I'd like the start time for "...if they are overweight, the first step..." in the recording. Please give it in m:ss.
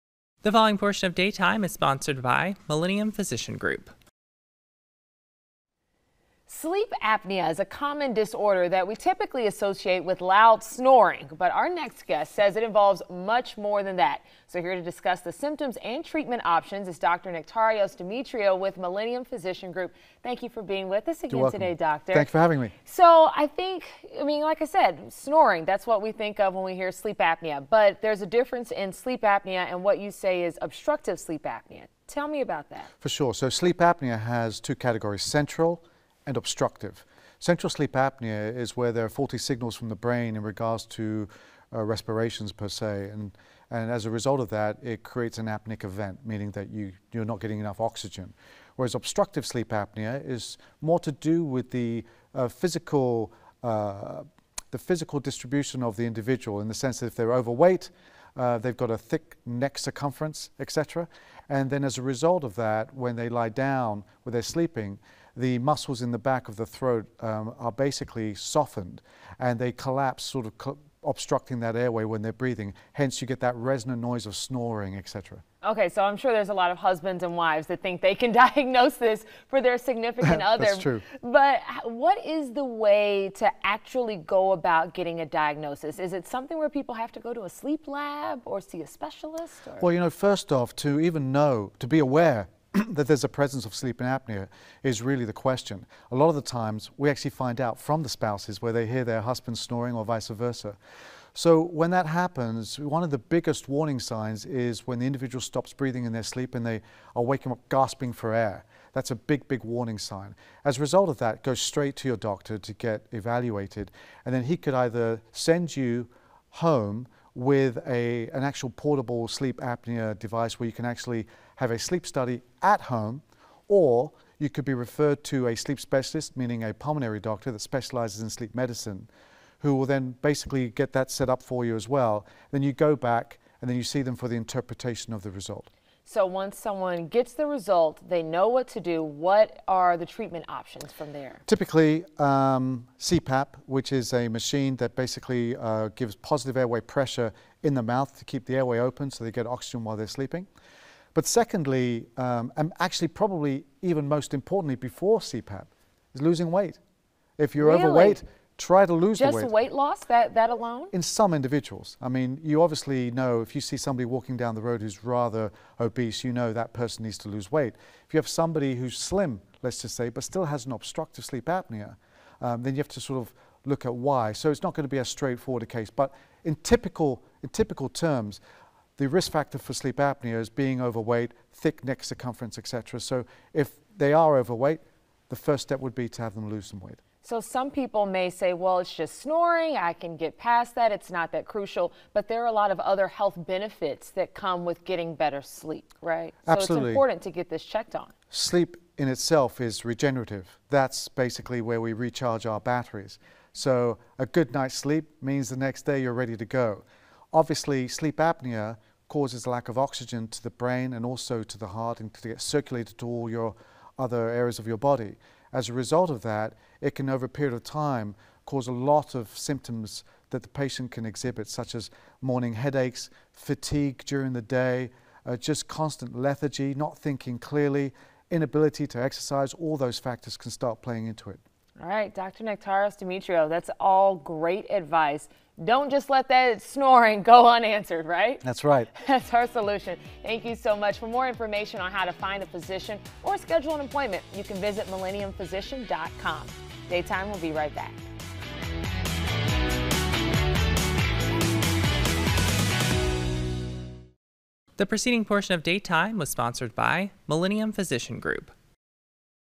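3:03.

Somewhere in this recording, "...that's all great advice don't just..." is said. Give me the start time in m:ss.
3:53.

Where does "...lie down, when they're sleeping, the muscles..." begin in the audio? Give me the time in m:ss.
1:03.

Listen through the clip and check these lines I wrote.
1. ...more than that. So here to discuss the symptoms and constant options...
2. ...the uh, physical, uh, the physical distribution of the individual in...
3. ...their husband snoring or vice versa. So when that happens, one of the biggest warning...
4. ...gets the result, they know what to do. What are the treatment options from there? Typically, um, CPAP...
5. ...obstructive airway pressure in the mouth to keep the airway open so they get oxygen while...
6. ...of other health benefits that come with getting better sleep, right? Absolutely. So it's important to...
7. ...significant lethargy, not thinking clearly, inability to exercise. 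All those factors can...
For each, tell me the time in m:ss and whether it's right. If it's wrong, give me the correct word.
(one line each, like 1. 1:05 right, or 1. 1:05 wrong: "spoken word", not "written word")
1. 0:13 wrong: "treatment", not "constant"
2. 0:51 right
3. 1:39 right
4. 2:17 right
5. 2:26 wrong: "positive", not "obstructive"
6. 3:12 right
7. 3:45 wrong: "constant", not "significant".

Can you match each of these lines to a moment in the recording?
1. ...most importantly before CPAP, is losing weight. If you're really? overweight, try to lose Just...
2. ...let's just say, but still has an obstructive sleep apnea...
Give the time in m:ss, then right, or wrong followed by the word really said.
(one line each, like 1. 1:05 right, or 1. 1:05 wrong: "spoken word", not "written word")
1. 2:34 right
2. 2:49 right.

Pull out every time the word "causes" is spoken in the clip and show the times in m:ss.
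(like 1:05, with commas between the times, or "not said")
3:29, 3:38.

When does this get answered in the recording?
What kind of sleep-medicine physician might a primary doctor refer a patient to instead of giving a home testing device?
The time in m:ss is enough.
2:06.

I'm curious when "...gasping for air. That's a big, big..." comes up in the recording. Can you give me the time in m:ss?
1:47.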